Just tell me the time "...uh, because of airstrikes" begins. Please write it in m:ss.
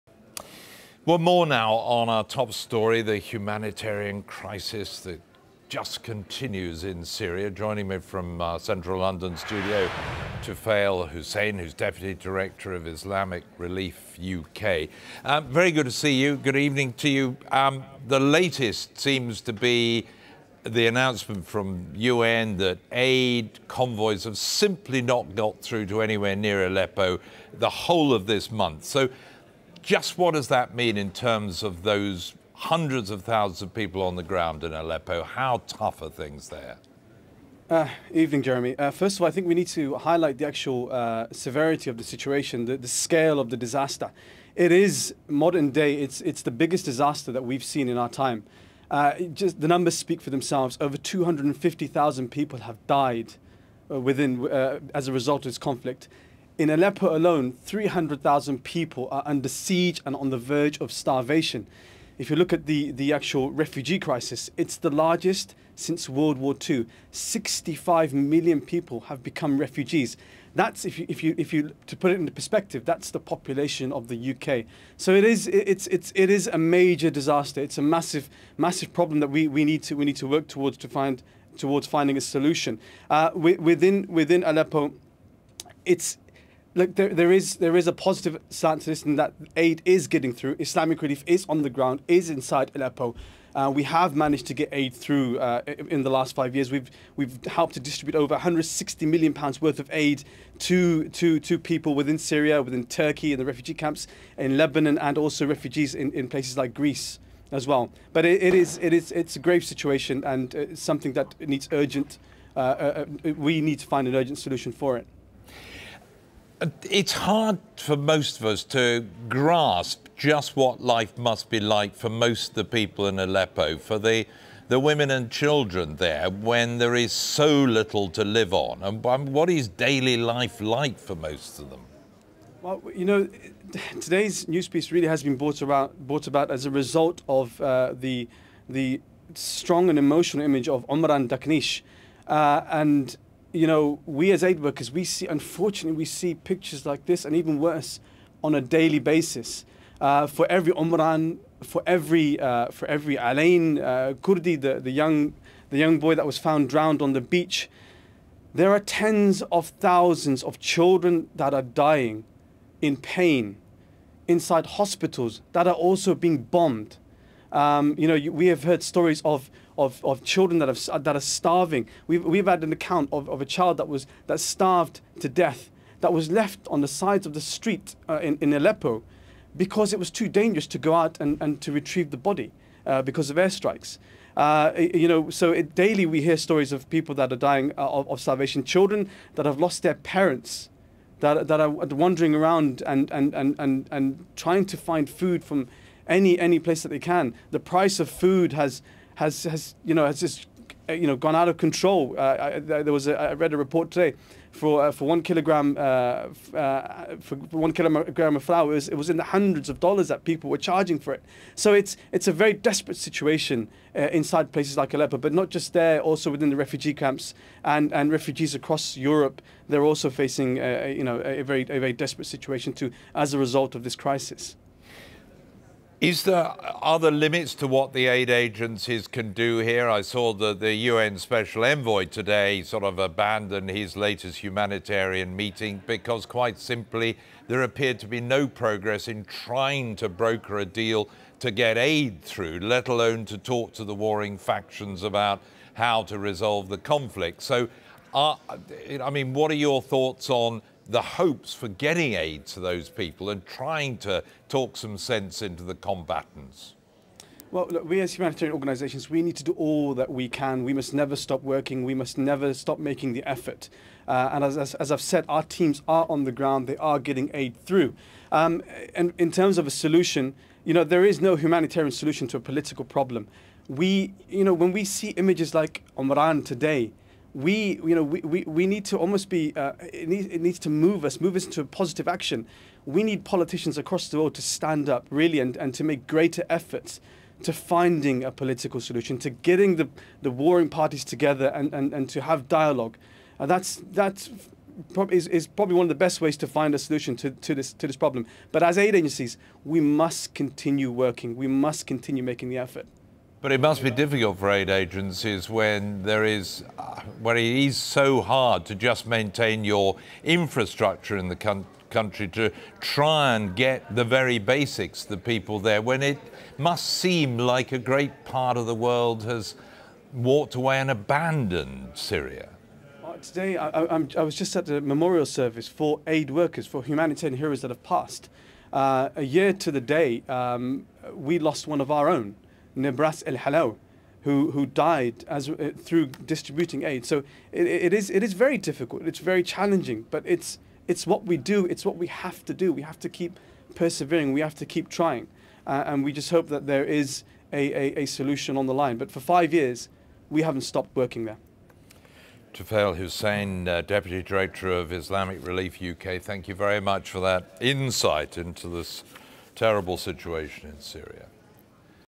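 3:02.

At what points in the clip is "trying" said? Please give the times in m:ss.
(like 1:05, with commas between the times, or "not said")
3:14, 3:59, 4:13, 5:44.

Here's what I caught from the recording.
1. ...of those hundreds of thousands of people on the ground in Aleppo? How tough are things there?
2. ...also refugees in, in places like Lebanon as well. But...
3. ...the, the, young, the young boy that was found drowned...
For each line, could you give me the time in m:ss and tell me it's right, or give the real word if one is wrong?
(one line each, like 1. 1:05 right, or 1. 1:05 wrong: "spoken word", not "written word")
1. 0:31 right
2. 1:45 wrong: "Greece", not "Lebanon"
3. 2:34 right.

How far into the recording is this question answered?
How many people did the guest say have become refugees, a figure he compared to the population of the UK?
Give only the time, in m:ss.
1:07.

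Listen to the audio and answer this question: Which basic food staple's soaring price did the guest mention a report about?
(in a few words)
Flour.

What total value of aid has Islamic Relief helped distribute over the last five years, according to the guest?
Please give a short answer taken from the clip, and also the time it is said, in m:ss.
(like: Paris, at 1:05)
160 million pounds, at 1:38.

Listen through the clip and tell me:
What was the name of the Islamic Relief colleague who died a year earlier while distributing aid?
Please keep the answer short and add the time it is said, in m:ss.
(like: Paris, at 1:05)
Nebras El Halawi, at 5:32.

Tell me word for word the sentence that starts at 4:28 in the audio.
Um, and in terms of a solution, you know, there is no humanitarian solution to a political problem.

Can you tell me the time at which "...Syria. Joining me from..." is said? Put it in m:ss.
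0:07.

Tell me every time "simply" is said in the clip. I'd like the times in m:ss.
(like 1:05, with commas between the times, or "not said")
0:24, 3:56.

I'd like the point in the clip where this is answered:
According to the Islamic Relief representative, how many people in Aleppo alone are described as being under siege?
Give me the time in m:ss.
0:57.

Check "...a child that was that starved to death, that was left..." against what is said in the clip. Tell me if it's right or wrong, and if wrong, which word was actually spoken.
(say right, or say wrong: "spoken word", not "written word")
right.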